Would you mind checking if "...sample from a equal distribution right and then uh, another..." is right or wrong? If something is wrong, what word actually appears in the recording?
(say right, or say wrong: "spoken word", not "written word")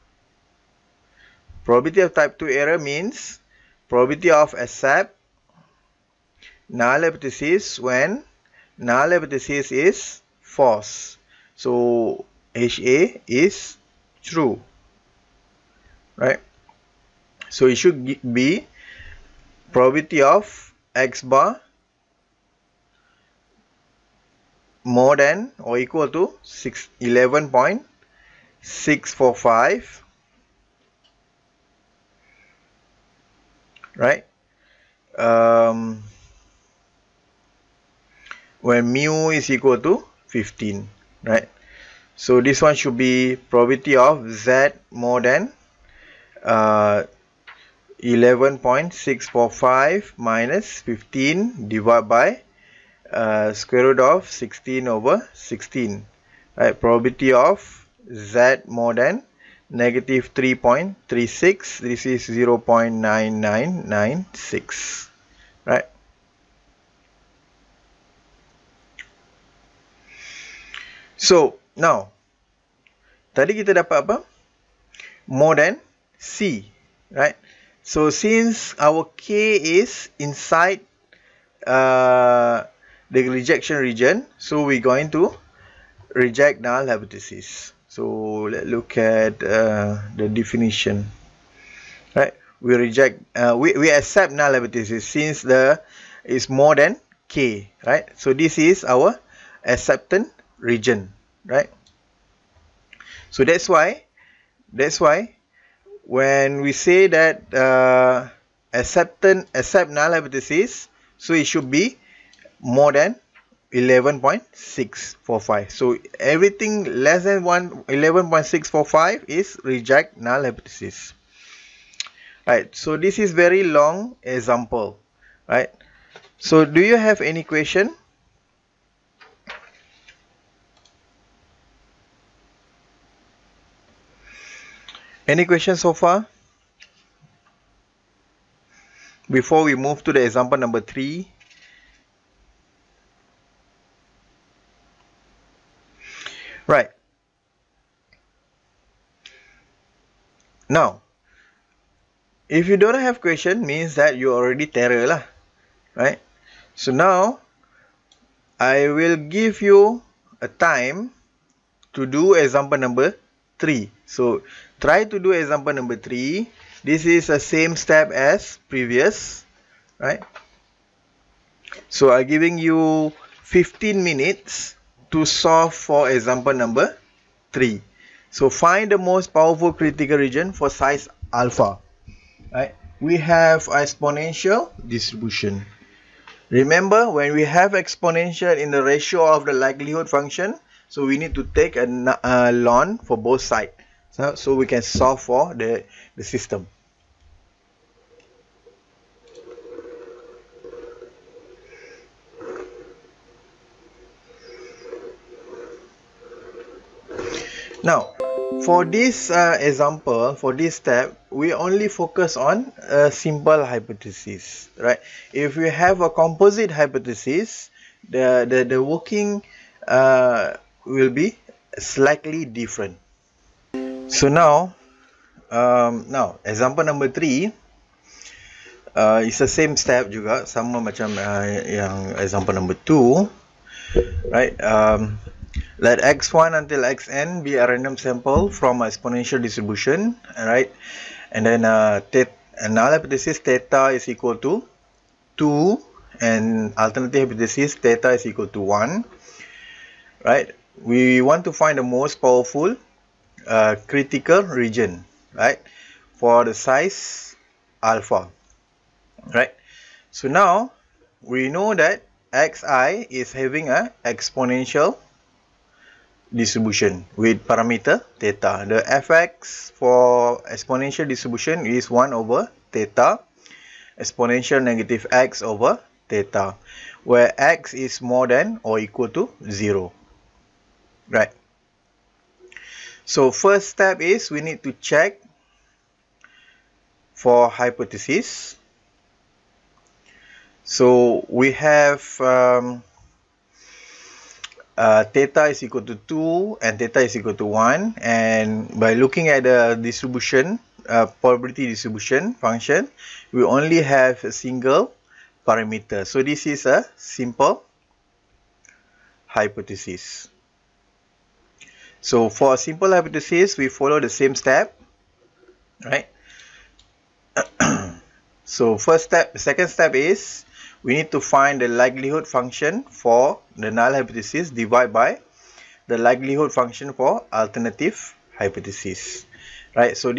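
wrong: "exponential", not "equal".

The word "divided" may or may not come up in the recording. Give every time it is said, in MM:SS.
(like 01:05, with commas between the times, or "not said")
00:51, 05:24.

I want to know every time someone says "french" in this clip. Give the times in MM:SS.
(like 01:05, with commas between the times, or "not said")
not said.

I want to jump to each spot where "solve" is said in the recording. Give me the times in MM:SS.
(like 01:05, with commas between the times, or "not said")
02:55, 03:14.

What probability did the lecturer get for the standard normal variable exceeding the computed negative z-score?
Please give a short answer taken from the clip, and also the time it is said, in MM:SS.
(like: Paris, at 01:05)
0.9996, at 01:01.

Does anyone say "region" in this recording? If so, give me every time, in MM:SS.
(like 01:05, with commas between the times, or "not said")
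01:23, 01:40, 03:00, 04:14.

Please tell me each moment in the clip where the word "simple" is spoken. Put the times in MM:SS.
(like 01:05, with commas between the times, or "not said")
03:33, 05:06, 05:12.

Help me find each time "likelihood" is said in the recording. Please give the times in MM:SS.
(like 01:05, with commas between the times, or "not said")
03:09, 05:21, 05:25.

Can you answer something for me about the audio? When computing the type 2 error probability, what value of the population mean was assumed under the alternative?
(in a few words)
15.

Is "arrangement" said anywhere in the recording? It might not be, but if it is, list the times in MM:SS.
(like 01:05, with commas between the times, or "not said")
not said.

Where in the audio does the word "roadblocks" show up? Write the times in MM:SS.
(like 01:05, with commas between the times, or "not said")
not said.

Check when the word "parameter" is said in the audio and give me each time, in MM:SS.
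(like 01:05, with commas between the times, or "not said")
04:27, 05:05.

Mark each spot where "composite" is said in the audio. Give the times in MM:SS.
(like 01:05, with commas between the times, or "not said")
03:36.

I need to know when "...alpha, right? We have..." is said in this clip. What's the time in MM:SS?
03:01.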